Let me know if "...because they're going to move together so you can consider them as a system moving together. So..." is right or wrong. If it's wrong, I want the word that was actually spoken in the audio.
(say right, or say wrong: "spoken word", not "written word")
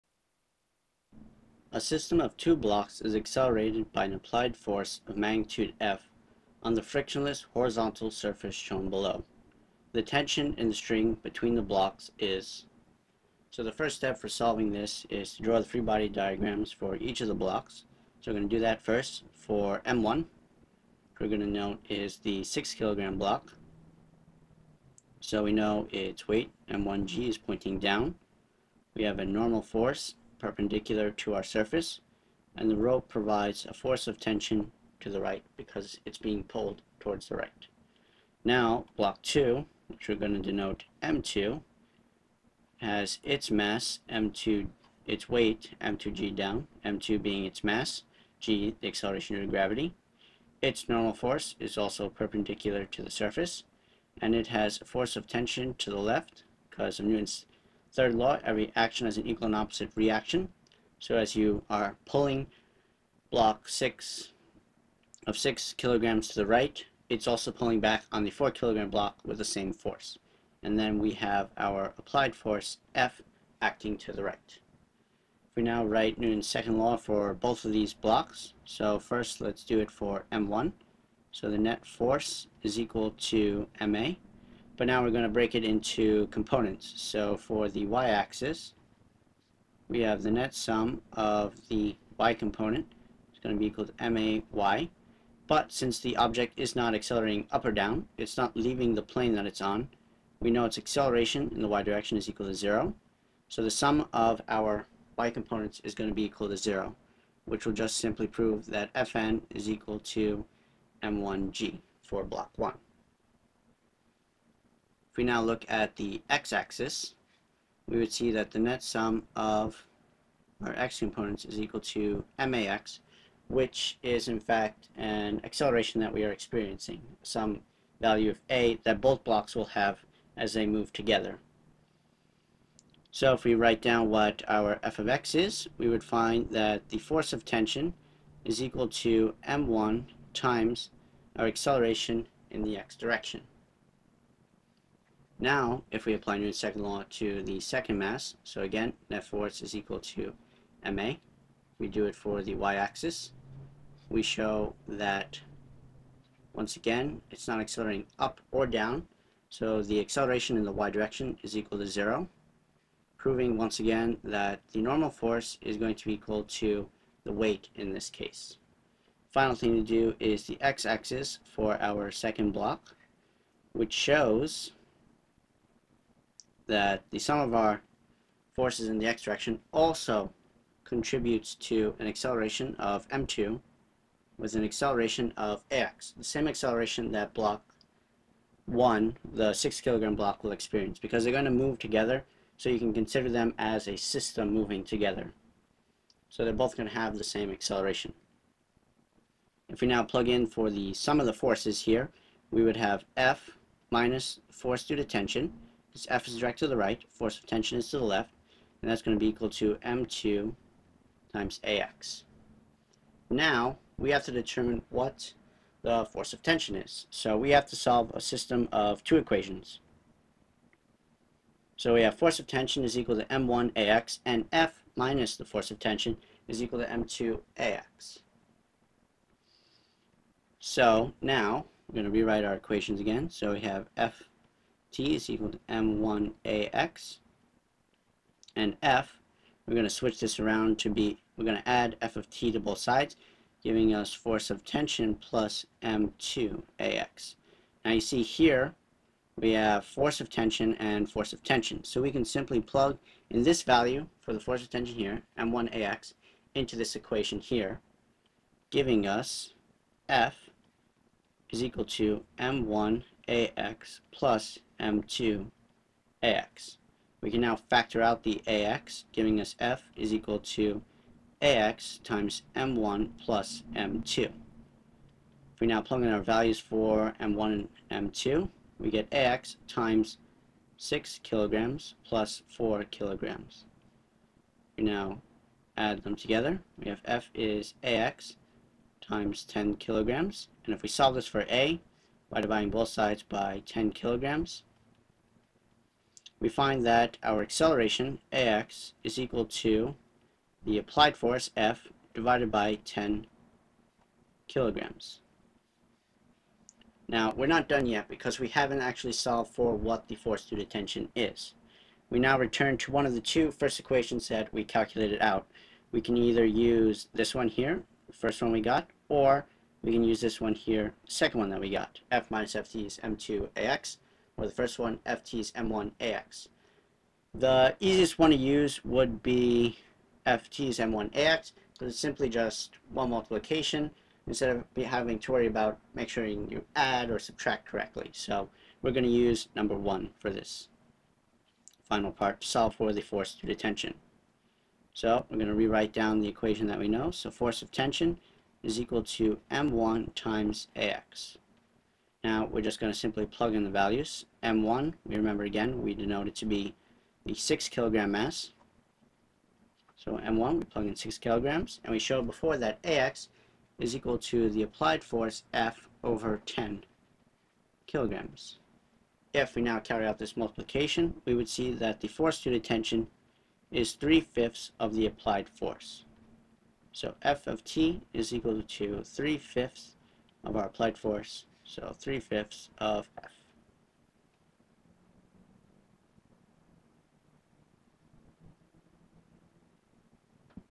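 right.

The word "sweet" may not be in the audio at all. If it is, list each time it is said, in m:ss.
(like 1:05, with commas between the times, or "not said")
not said.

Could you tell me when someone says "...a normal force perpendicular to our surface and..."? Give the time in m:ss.
0:29.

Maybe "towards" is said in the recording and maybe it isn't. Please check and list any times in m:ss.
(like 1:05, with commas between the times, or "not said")
0:36.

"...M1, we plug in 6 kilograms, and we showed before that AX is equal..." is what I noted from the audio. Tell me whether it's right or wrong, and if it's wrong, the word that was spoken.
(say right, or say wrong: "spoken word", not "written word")
right.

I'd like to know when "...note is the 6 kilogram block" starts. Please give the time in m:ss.
0:21.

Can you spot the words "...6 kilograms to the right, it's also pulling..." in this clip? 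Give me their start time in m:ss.
1:05.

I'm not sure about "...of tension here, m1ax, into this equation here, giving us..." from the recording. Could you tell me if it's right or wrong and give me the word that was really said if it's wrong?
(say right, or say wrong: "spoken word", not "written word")
right.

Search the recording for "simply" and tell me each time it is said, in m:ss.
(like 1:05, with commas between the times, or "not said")
1:47, 4:12, 5:31, 5:52.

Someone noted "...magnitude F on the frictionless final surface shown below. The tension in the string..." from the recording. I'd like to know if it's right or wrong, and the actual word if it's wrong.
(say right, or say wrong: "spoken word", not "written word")
wrong: "horizontal", not "final".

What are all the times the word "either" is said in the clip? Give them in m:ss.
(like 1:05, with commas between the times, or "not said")
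5:16.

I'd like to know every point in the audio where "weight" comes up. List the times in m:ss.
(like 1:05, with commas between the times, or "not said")
0:26, 0:45, 2:47.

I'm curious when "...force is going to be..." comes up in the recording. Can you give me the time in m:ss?
2:45.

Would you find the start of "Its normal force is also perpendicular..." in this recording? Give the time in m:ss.
0:50.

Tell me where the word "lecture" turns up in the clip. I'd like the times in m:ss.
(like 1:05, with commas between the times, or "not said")
not said.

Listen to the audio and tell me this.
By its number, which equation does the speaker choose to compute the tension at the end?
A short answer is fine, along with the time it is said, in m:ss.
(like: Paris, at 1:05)
1, at 5:39.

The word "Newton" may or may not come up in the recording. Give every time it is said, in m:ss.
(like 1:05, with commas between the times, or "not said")
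0:57, 1:16, 2:26.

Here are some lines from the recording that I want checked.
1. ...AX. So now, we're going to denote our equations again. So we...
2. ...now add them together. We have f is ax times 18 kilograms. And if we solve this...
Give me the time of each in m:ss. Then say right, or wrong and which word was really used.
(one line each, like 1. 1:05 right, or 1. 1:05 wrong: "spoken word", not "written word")
1. 3:47 wrong: "rewrite", not "denote"
2. 4:44 wrong: "10", not "18".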